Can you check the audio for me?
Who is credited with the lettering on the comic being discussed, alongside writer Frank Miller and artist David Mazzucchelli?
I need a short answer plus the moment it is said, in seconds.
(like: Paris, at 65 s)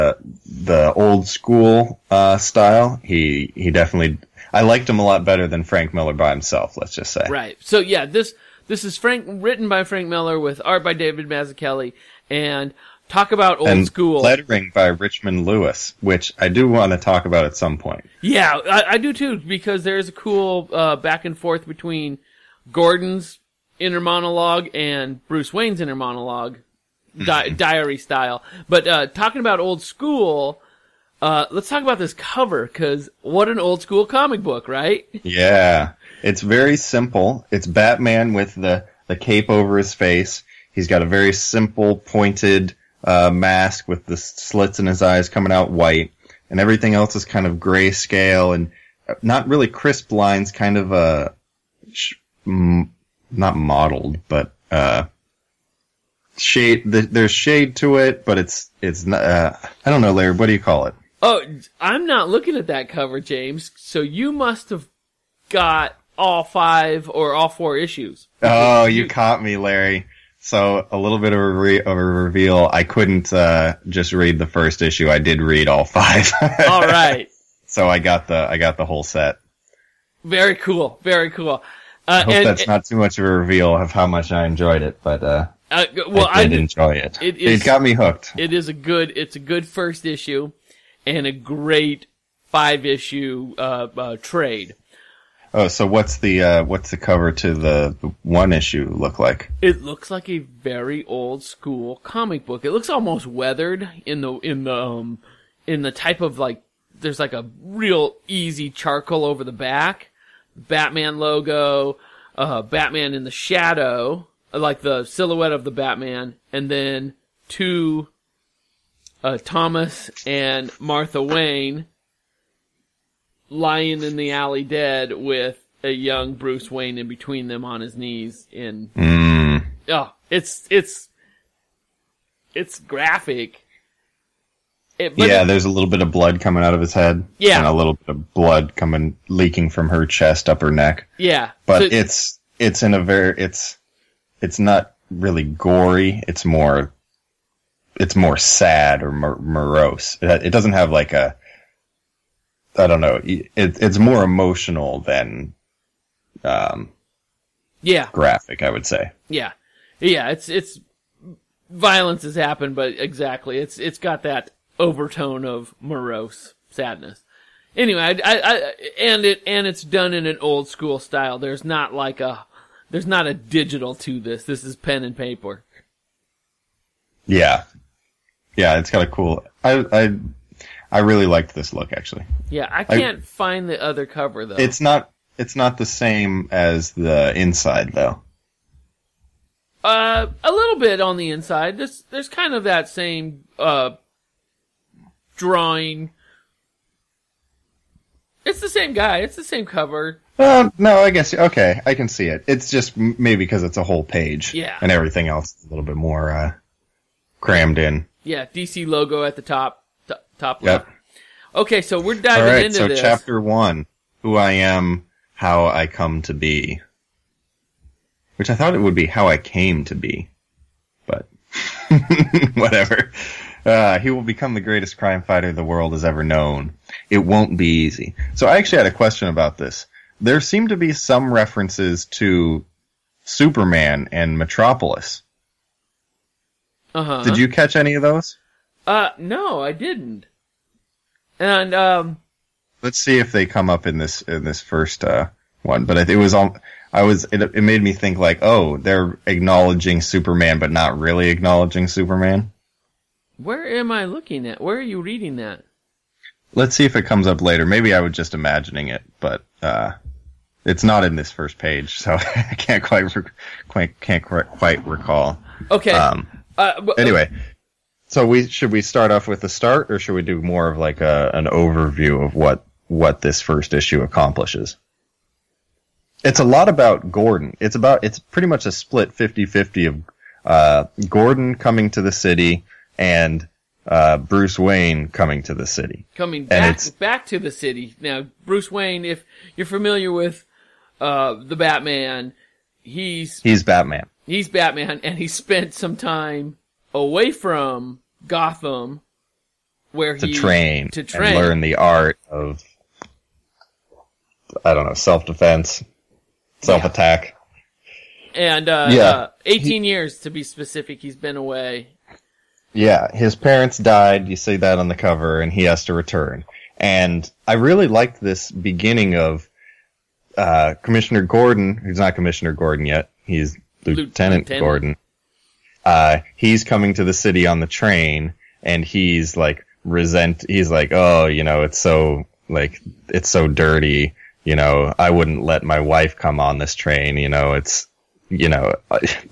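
Richmond Lewis, at 14 s.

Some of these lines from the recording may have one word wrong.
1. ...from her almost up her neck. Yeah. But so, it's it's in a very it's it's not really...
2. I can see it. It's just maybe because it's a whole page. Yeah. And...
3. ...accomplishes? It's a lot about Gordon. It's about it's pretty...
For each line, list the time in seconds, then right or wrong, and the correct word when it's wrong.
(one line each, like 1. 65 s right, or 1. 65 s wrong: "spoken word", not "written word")
1. 139 s wrong: "chest", not "almost"
2. 201 s right
3. 274 s right.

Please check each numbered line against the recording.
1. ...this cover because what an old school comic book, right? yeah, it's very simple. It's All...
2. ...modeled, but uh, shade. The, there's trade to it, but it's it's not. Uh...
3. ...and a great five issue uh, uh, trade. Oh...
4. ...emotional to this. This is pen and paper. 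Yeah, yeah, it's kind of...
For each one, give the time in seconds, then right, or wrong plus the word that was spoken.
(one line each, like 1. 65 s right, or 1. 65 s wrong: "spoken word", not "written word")
1. 31 s wrong: "Batman", not "All"
2. 53 s wrong: "shade", not "trade"
3. 91 s right
4. 173 s wrong: "digital", not "emotional".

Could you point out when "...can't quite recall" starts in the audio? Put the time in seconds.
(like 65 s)
264 s.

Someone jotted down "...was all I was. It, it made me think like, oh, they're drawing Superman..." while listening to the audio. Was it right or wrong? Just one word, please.
wrong.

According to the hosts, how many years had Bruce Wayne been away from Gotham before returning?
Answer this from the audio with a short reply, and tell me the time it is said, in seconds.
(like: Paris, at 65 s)
18, at 309 s.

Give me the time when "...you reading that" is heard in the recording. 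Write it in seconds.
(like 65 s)
254 s.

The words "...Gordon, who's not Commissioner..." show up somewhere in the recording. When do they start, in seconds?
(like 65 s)
321 s.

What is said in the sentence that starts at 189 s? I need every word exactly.
Uh, a little bit on the inside.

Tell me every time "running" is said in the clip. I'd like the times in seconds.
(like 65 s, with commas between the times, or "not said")
not said.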